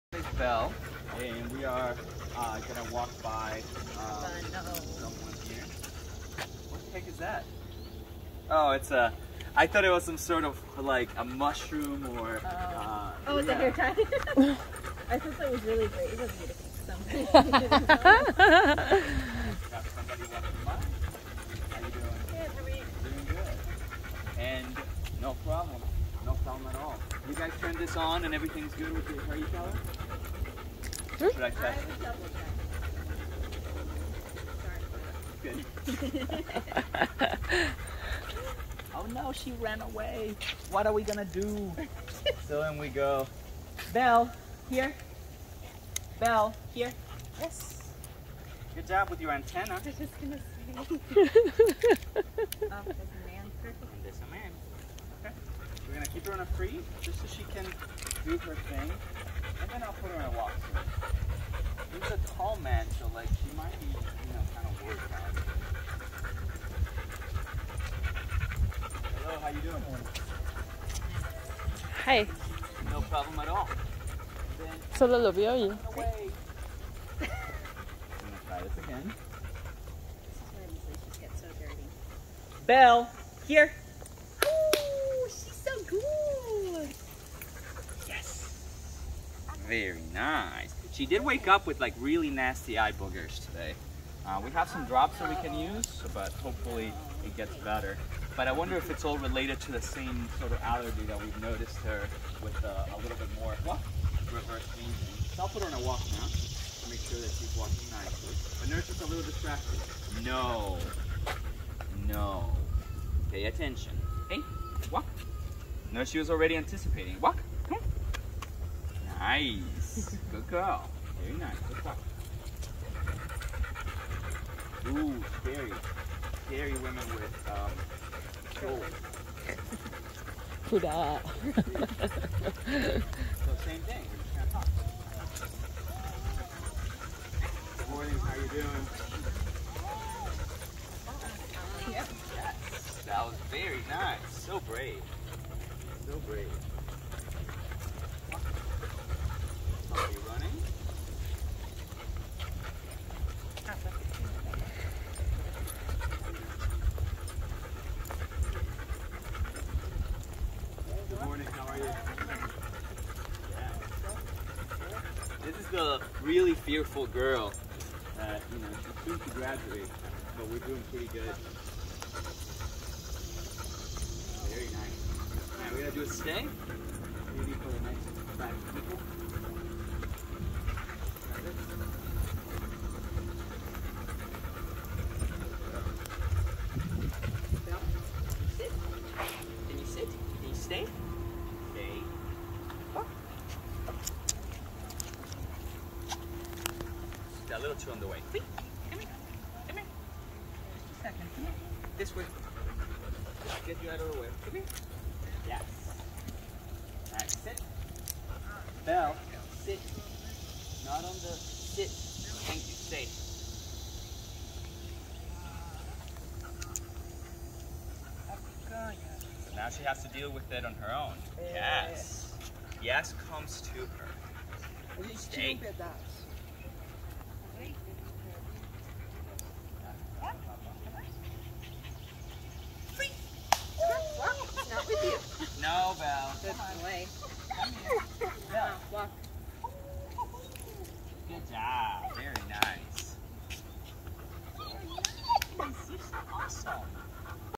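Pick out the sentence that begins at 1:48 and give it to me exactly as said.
But nurse is a little distracted.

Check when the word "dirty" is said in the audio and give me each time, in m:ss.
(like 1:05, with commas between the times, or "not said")
1:21.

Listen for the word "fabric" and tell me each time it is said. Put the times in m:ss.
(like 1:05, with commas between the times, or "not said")
not said.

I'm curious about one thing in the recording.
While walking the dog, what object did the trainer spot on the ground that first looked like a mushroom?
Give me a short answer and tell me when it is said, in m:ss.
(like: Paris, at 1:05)
hair tie, at 0:13.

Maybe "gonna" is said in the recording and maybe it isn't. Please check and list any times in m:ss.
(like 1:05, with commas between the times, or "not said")
0:02, 0:41, 0:50, 0:55, 2:14, 2:55.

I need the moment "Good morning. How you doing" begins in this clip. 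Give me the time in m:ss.
2:17.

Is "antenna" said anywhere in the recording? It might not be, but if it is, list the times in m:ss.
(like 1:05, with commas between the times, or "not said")
0:49.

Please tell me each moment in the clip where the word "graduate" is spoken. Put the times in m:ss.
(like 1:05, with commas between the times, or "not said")
2:49.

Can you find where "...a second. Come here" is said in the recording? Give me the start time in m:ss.
3:20.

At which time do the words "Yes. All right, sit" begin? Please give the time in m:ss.
3:25.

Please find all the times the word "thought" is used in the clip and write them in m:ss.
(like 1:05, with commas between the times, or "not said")
0:09, 0:15.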